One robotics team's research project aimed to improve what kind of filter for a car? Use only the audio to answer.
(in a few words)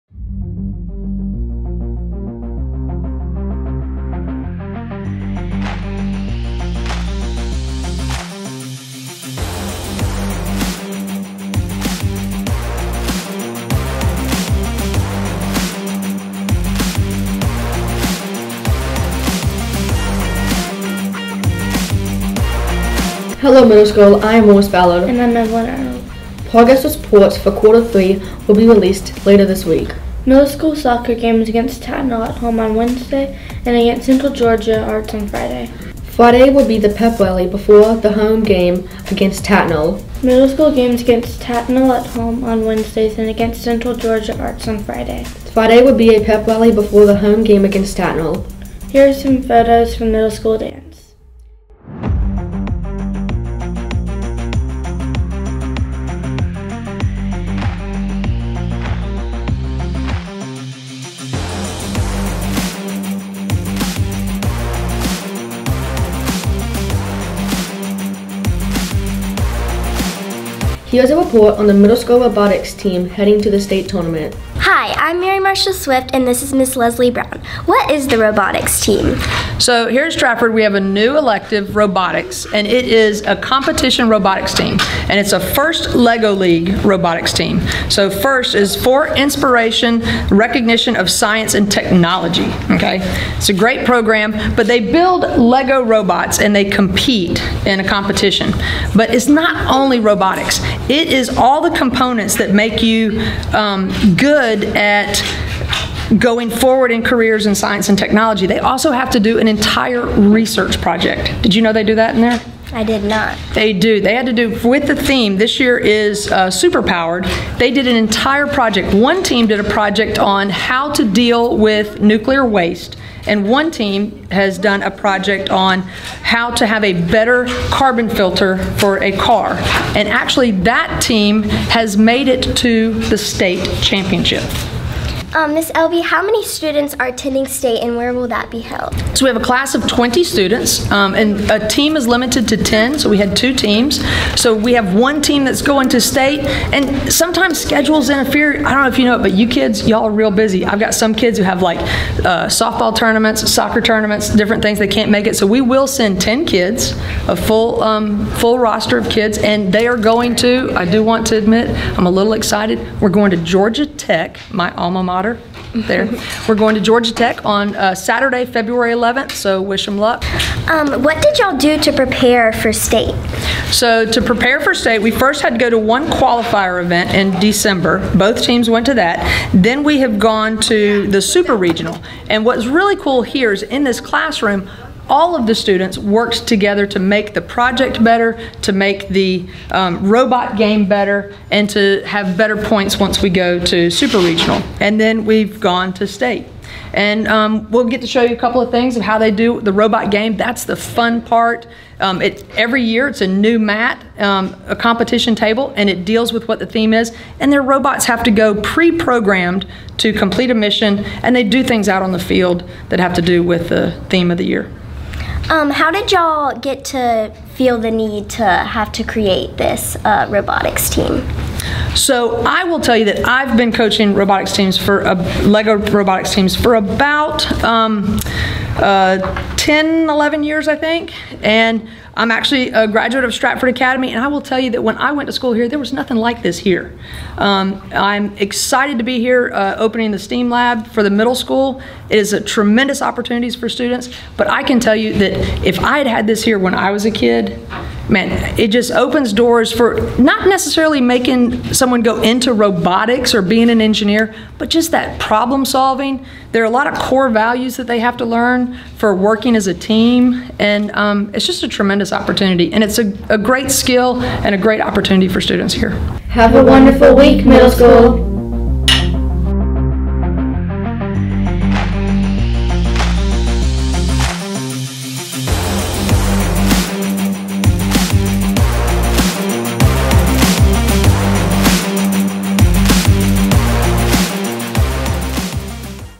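carbon filter.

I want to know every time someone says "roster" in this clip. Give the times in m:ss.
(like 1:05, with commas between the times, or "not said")
2:38.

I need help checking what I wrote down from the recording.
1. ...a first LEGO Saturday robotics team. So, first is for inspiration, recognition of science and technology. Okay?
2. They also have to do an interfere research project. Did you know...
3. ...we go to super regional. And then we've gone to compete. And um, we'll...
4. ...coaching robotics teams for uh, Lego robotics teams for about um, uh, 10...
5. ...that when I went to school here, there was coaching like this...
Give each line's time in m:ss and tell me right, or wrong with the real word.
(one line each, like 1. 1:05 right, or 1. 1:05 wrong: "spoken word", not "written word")
1. 1:25 wrong: "League", not "Saturday"
2. 1:48 wrong: "entire", not "interfere"
3. 3:13 wrong: "state", not "compete"
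4. 3:43 right
5. 3:54 wrong: "nothing", not "coaching".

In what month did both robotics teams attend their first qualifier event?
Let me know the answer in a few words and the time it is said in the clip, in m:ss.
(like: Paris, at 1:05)
December, at 2:57.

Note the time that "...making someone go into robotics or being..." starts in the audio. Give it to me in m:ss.
4:10.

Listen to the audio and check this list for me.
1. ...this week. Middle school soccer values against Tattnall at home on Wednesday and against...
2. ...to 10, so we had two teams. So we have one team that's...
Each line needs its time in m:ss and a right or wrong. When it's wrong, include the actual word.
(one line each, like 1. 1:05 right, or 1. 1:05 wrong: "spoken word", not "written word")
1. 0:29 wrong: "games", not "values"
2. 2:22 right.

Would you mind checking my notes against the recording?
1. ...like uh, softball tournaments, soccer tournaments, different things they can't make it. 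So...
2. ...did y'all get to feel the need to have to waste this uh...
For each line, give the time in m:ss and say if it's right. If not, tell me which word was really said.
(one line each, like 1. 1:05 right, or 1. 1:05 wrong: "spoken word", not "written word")
1. 2:31 right
2. 3:35 wrong: "create", not "waste".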